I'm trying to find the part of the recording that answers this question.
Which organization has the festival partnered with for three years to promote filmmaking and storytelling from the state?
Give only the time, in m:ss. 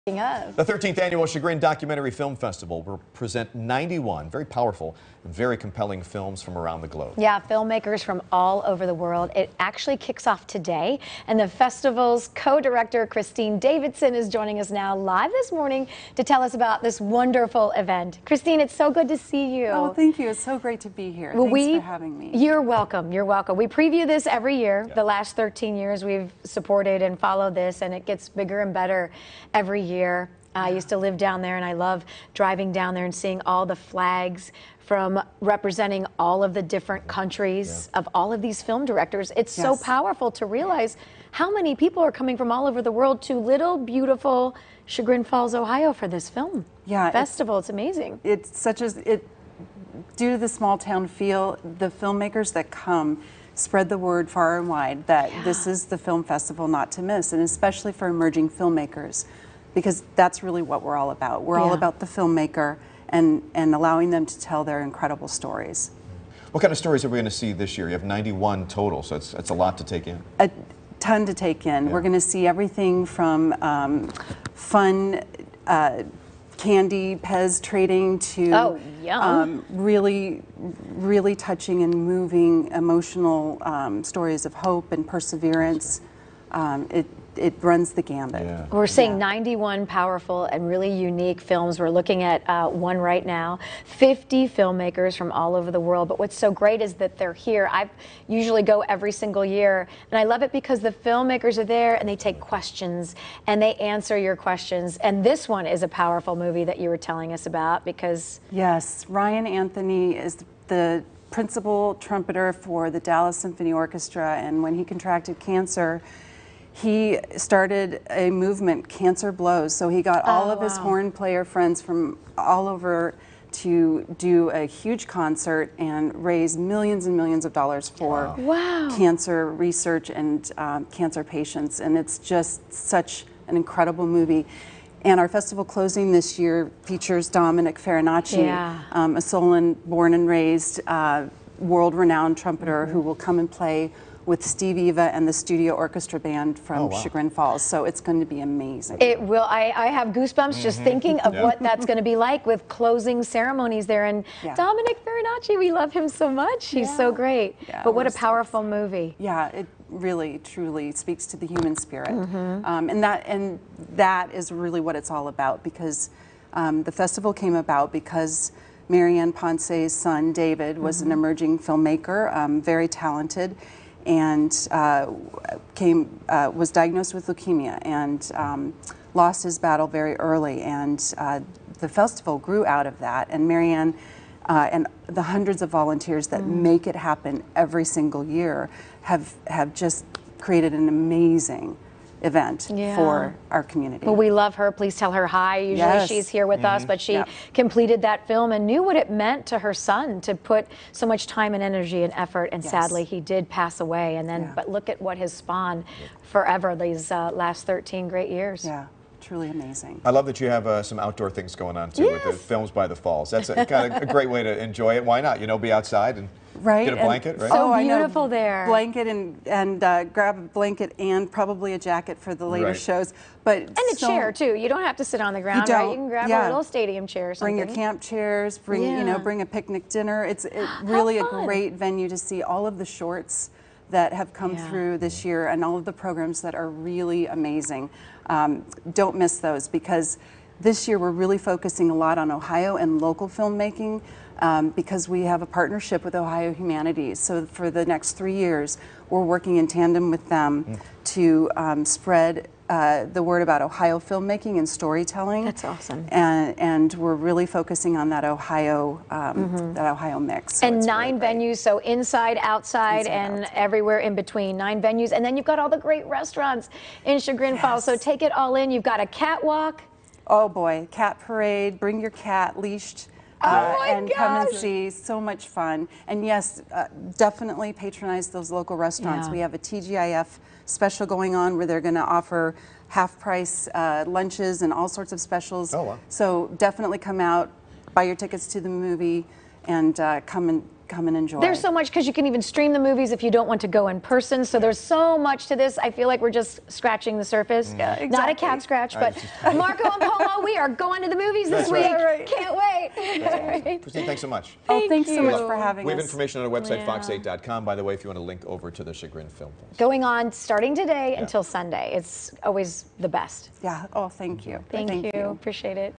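4:06.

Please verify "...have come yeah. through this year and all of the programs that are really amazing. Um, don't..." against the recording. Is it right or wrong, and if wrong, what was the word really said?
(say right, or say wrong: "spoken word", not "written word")
right.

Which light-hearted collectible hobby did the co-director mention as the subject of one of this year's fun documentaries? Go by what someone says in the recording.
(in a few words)
Pez trading.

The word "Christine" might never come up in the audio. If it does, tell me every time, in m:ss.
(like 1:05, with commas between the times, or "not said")
0:13, 0:18, 5:03.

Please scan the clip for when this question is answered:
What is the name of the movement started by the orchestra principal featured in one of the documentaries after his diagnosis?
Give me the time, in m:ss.
1:58.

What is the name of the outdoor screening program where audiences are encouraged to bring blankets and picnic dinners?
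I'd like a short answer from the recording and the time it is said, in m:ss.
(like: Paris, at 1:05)
Films by the Falls, at 3:32.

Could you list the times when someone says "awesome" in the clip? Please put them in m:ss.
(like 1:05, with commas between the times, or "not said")
4:15, 5:02.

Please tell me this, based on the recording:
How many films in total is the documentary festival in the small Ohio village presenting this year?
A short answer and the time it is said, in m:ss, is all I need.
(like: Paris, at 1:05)
91, at 0:03.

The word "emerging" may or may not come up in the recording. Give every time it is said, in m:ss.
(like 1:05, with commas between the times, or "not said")
0:58, 2:51.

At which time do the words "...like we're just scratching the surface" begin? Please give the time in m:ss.
4:56.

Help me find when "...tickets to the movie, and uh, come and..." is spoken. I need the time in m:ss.
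4:48.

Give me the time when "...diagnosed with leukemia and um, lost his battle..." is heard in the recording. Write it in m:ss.
2:56.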